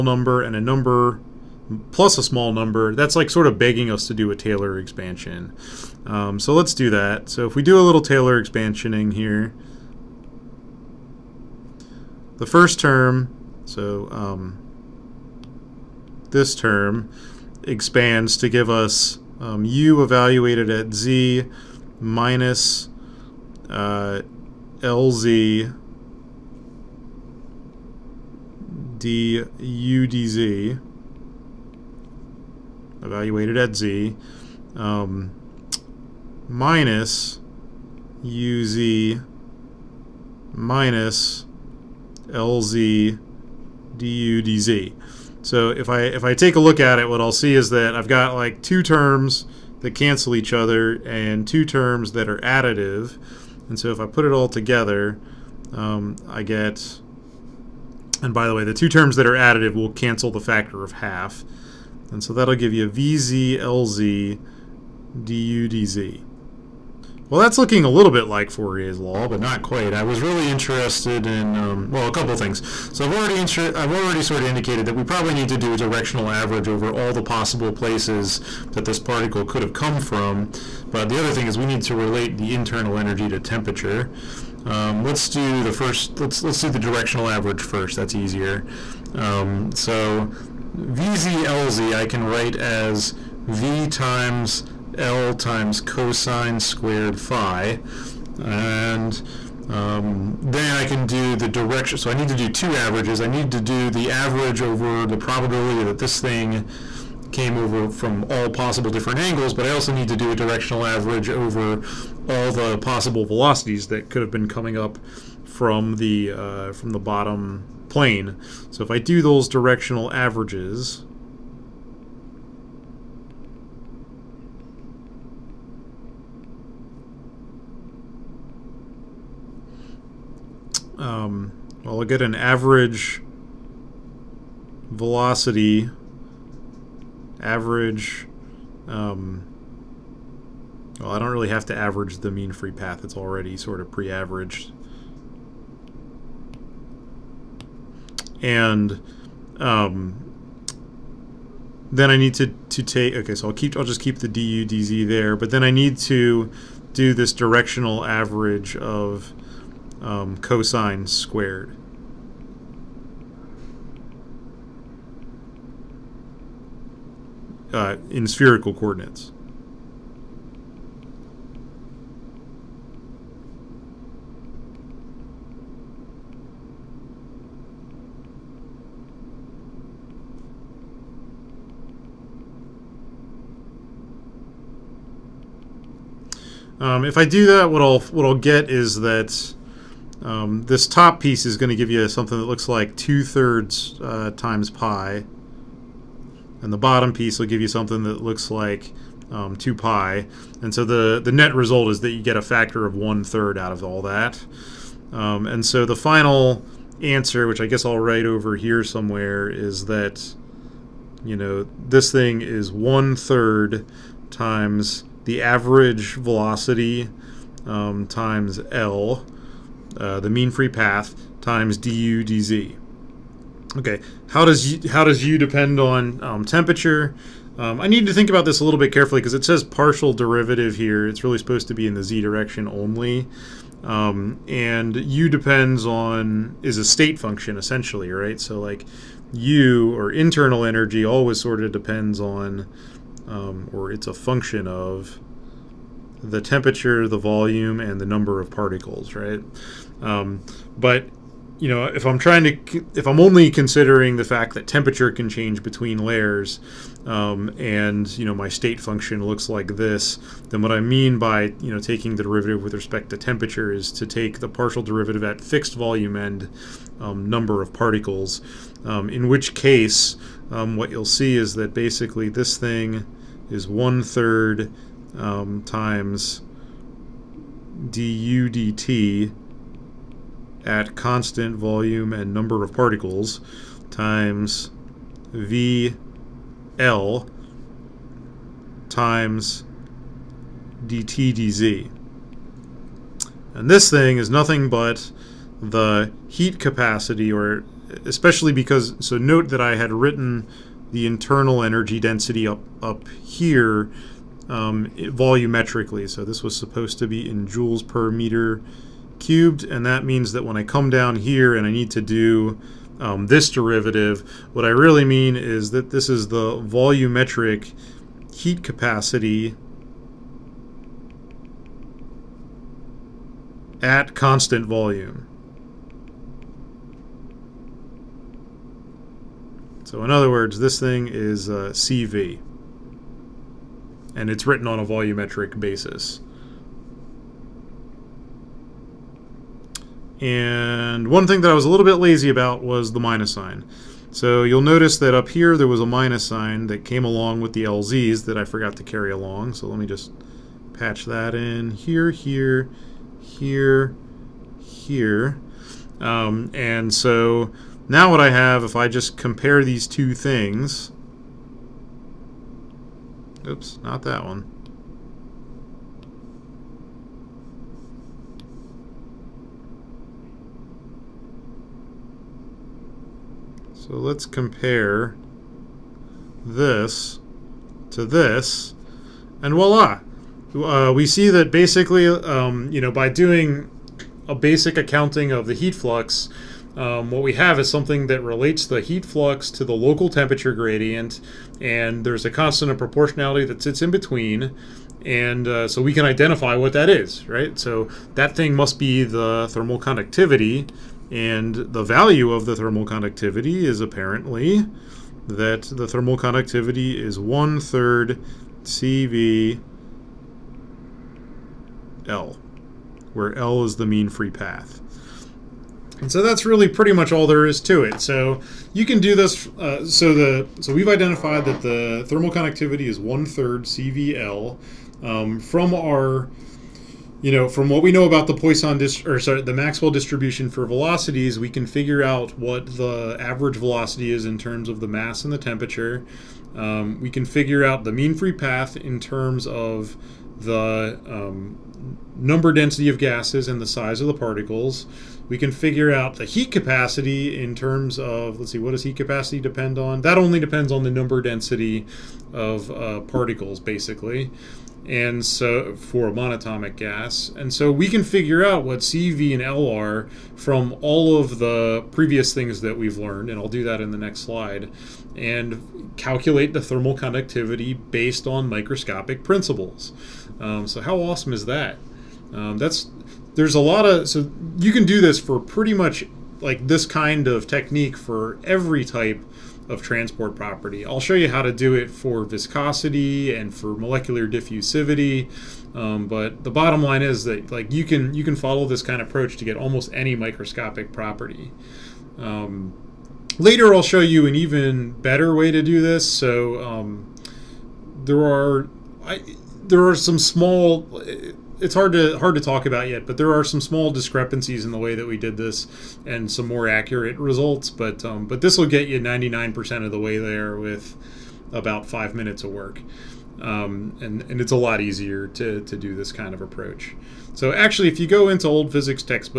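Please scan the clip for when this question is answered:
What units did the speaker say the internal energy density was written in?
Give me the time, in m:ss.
5:07.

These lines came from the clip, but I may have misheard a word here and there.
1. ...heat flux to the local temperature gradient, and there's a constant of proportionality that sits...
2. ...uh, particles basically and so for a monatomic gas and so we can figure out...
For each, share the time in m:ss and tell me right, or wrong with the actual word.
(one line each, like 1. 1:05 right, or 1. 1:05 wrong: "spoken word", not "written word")
1. 6:28 right
2. 7:32 right.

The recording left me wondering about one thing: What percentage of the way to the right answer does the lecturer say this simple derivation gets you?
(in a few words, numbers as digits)
99%.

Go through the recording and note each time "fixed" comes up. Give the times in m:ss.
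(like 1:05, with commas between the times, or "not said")
4:25.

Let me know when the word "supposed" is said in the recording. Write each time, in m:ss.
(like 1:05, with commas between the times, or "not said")
3:51, 5:06.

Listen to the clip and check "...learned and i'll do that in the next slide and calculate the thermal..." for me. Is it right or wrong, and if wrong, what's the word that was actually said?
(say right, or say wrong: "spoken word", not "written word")
right.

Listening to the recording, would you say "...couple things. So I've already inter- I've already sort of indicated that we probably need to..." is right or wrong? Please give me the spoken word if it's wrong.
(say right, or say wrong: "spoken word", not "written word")
right.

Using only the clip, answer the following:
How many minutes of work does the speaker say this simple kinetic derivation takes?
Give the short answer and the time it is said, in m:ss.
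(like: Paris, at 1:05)
5, at 8:31.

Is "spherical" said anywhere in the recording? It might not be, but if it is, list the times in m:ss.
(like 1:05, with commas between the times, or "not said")
2:48.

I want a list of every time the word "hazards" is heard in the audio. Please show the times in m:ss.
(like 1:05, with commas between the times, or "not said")
not said.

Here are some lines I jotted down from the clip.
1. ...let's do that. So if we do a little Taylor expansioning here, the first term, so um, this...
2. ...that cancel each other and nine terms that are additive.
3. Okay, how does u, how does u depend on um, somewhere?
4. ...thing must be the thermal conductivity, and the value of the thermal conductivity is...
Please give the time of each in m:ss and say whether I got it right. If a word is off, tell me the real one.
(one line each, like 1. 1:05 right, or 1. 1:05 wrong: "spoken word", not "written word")
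1. 0:06 right
2. 0:49 wrong: "two", not "nine"
3. 3:43 wrong: "temperature", not "somewhere"
4. 6:38 right.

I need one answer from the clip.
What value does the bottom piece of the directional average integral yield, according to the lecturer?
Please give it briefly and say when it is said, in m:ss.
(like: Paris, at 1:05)
2 pi, at 3:19.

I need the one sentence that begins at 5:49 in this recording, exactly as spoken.
So let me just patch that in here, here, here, here.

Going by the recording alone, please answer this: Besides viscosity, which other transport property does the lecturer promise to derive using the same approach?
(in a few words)
molecular diffusivity.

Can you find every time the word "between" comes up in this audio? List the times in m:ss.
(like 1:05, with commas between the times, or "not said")
4:15, 6:33.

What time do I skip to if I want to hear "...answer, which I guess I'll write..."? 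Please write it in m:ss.
3:27.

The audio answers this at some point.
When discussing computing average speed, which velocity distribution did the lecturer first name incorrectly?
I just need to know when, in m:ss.
7:09.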